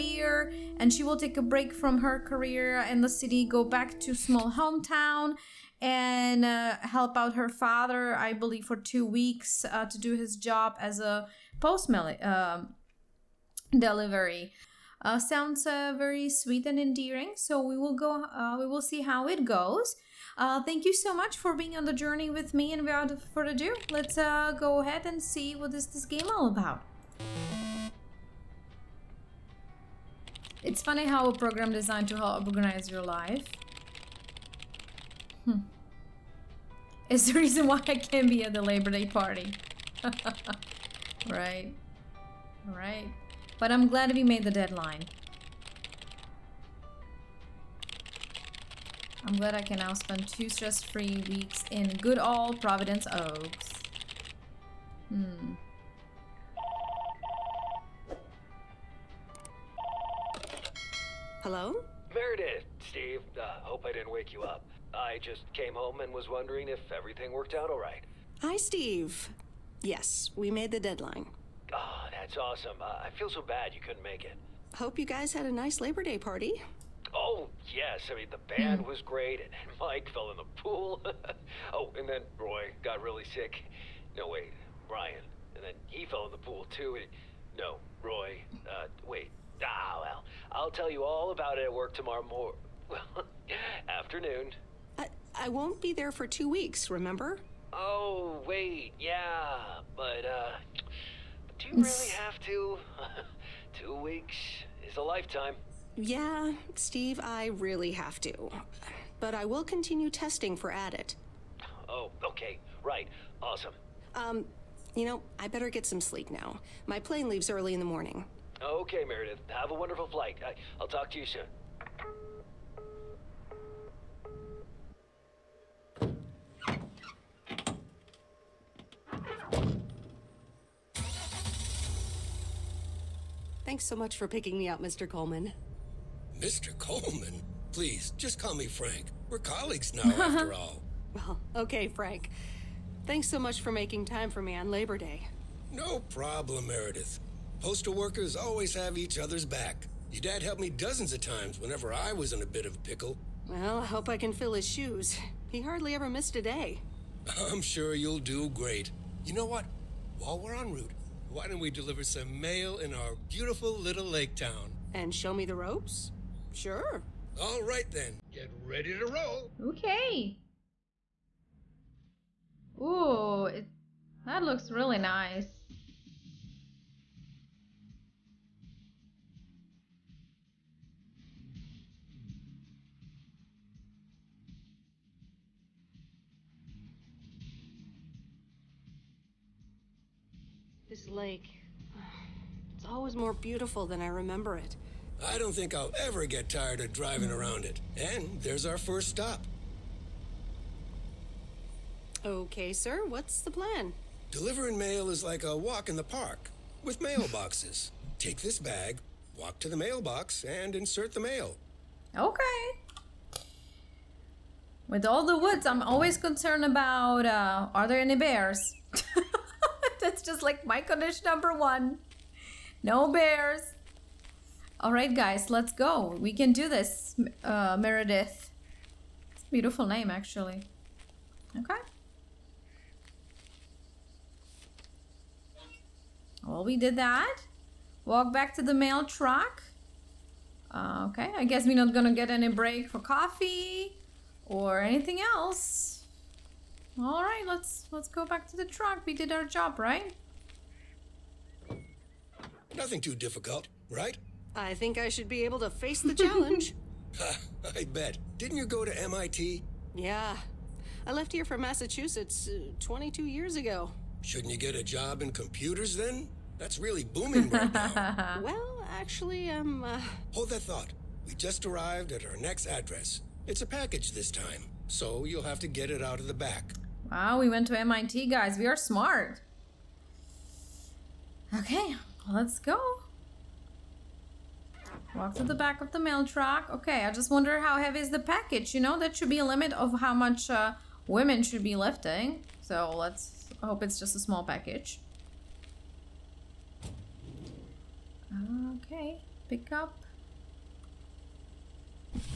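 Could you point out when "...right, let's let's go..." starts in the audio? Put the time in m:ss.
4:07.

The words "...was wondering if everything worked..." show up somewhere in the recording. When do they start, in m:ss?
1:06.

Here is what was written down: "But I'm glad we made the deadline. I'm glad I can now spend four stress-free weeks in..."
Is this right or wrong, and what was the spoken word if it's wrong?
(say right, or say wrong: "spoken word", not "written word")
wrong: "two", not "four".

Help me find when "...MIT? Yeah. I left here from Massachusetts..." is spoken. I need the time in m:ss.
4:19.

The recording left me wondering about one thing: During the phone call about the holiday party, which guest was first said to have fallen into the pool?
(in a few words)
Mike.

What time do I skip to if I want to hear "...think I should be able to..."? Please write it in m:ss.
4:14.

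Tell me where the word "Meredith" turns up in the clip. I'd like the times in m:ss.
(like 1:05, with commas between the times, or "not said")
1:02, 1:59, 2:26, 3:47.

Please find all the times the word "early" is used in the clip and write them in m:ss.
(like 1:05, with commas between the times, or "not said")
1:57.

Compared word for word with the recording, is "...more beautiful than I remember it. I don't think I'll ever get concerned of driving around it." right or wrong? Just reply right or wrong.
wrong.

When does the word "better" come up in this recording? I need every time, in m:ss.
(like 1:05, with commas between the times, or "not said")
1:55.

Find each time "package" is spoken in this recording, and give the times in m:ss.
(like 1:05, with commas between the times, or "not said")
4:33, 4:48, 4:54.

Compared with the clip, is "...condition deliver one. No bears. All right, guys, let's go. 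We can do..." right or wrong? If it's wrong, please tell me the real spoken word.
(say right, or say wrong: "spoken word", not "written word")
wrong: "number", not "deliver".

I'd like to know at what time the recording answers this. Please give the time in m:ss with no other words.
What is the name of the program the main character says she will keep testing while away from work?
1:50.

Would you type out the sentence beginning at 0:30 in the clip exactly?
It's funny how a program designed to help organize your life.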